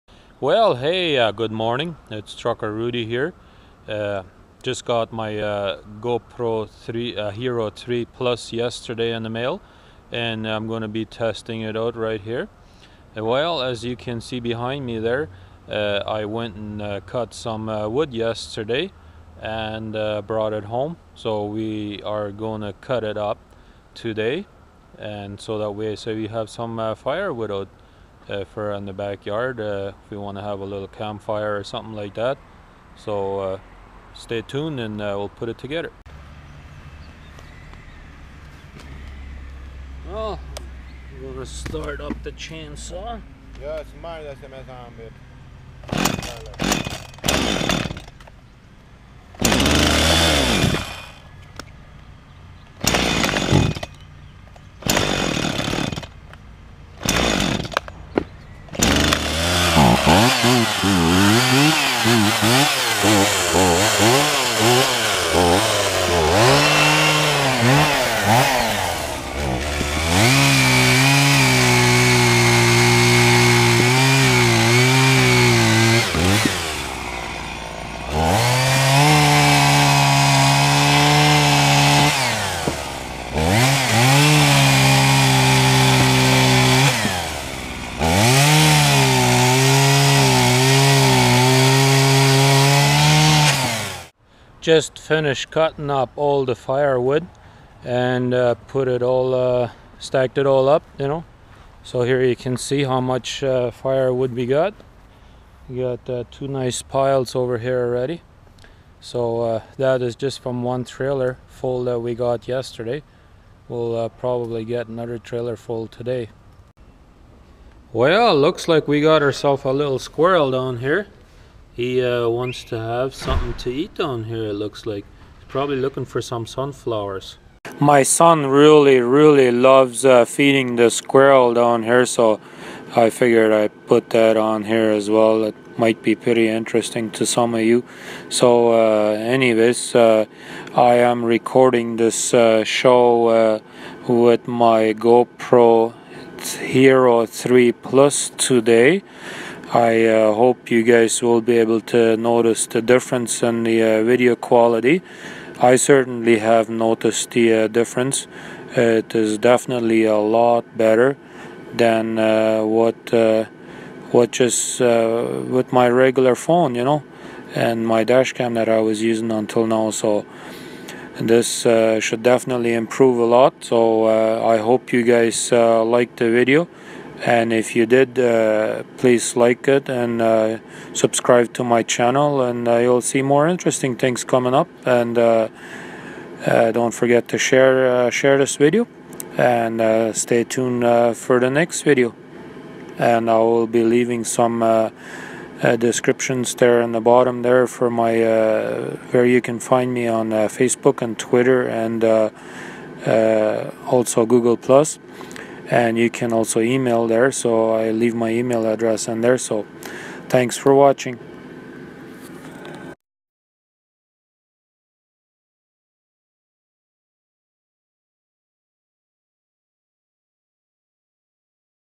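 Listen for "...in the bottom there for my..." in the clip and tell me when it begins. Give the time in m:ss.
3:16.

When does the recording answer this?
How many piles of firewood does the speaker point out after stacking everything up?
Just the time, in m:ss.
1:46.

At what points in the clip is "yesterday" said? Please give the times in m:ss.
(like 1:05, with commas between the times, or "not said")
0:08, 0:18, 1:52.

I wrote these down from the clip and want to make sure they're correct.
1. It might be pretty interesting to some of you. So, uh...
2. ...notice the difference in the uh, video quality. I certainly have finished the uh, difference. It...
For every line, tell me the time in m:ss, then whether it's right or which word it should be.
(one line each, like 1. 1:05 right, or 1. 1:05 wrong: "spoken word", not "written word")
1. 2:15 right
2. 2:32 wrong: "noticed", not "finished".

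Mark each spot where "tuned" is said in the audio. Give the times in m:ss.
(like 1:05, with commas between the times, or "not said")
0:34, 3:10.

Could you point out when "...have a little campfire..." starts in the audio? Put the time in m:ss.
0:30.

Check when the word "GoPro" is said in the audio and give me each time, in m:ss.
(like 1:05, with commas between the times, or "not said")
0:05, 2:24.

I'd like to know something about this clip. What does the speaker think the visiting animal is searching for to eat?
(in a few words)
Sunflowers.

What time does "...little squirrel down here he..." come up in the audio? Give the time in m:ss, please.
1:59.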